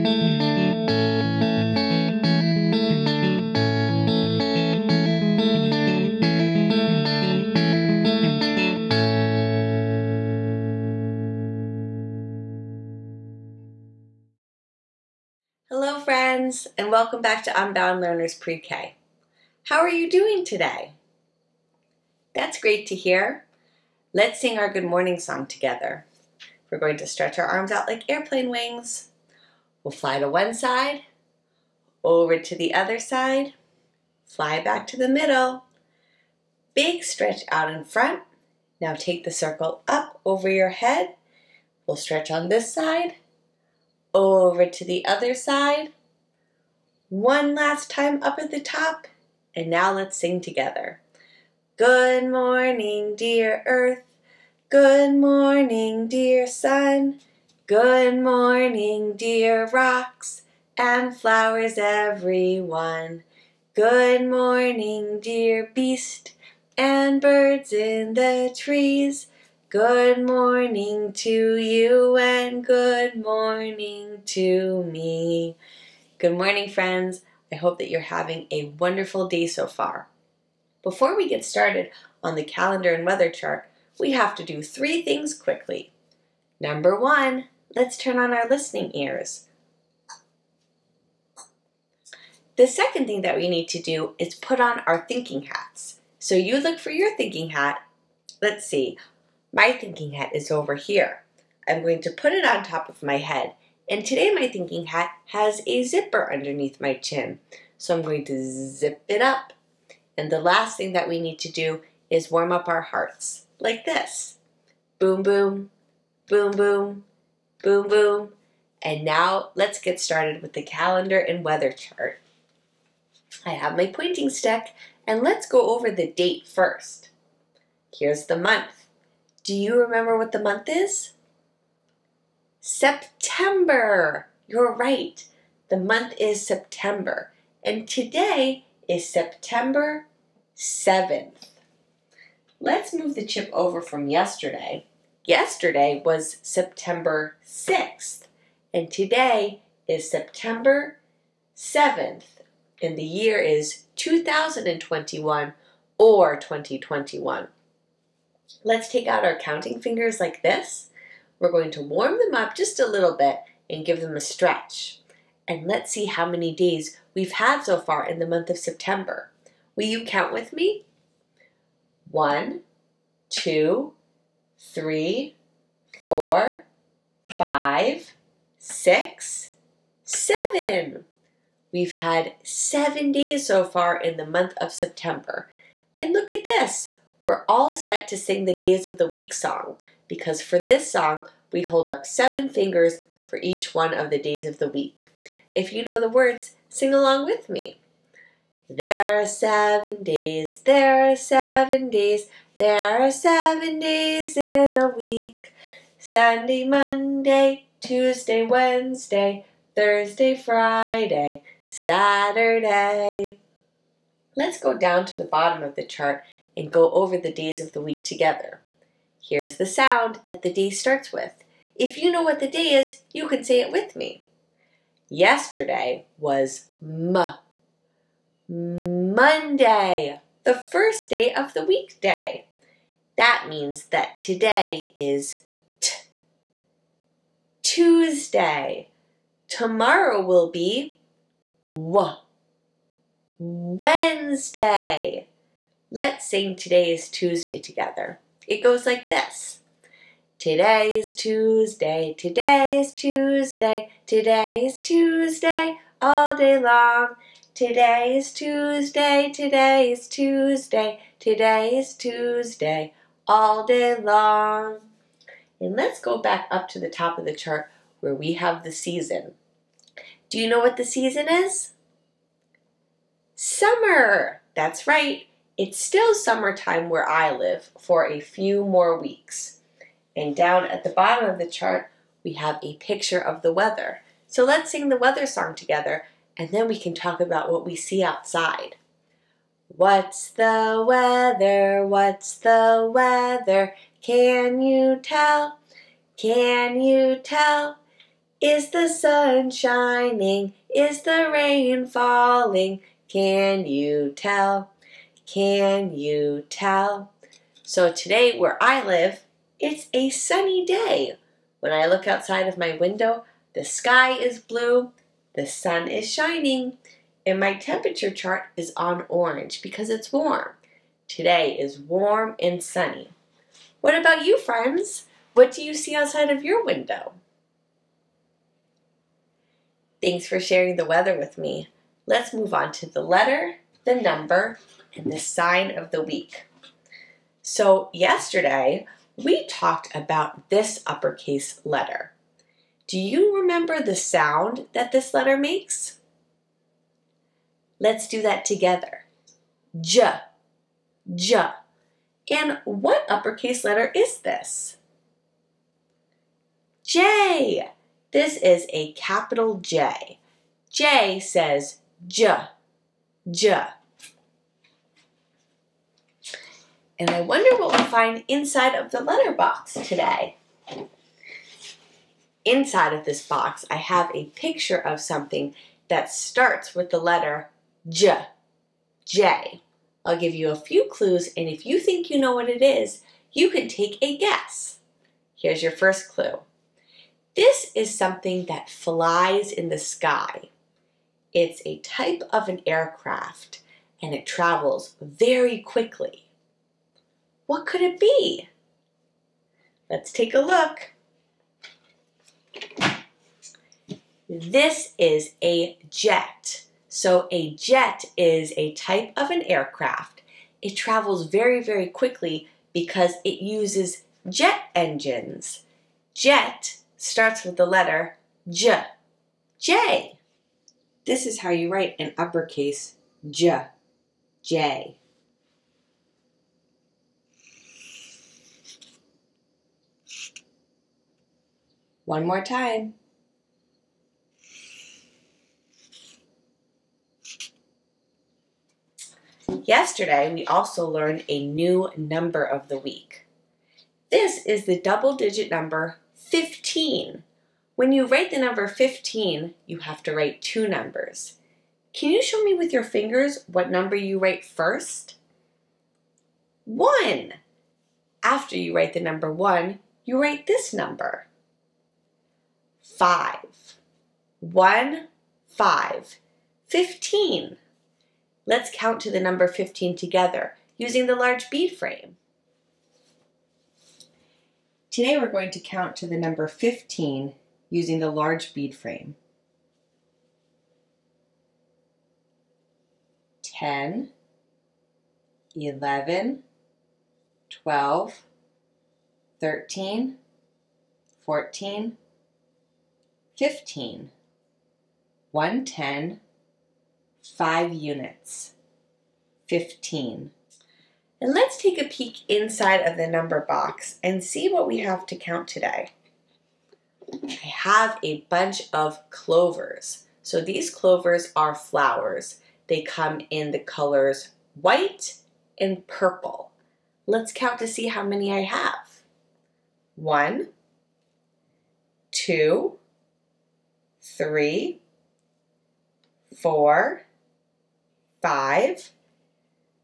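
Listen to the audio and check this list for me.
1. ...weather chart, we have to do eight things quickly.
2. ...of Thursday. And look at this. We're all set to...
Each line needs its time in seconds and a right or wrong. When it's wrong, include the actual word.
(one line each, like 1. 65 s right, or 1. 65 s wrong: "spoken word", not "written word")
1. 83 s wrong: "three", not "eight"
2. 184 s wrong: "September", not "Thursday".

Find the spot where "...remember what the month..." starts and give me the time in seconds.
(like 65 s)
129 s.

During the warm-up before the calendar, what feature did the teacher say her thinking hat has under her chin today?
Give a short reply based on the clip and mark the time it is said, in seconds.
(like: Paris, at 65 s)
A zipper, at 105 s.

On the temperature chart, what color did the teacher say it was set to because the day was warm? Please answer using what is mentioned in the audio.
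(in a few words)
Orange.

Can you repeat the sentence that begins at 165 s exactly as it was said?
And let's see how many days we've had so far in the month of September.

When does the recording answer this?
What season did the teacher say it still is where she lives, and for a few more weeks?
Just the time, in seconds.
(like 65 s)
273 s.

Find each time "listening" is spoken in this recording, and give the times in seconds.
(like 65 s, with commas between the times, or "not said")
88 s.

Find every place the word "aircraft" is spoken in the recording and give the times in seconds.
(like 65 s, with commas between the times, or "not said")
392 s, 409 s.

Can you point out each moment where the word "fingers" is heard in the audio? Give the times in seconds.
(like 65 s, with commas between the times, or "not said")
159 s, 192 s, 452 s.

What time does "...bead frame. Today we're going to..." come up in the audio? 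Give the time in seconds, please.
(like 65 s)
471 s.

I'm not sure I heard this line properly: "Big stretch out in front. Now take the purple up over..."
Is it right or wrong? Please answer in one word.
wrong.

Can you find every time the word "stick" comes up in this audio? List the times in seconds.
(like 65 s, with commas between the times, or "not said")
124 s.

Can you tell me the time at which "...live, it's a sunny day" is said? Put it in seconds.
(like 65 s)
308 s.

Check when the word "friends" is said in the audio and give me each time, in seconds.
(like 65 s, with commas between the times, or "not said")
76 s, 324 s.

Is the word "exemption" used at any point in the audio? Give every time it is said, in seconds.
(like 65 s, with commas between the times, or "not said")
not said.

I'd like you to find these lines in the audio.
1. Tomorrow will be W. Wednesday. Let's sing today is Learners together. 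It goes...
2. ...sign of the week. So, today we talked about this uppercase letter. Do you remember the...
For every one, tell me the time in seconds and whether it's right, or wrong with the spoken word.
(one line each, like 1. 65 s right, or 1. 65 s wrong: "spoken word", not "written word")
1. 239 s wrong: "Tuesday", not "Learners"
2. 335 s wrong: "yesterday", not "today".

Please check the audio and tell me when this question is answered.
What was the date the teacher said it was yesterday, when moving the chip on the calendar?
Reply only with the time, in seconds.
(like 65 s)
146 s.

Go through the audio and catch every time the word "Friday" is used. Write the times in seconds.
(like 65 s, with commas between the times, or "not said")
210 s.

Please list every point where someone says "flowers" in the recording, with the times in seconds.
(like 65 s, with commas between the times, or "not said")
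61 s, 511 s.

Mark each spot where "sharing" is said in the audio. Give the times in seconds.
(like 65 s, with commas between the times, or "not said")
330 s.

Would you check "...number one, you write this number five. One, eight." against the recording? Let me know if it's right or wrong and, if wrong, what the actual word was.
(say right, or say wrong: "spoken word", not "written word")
wrong: "five", not "eight".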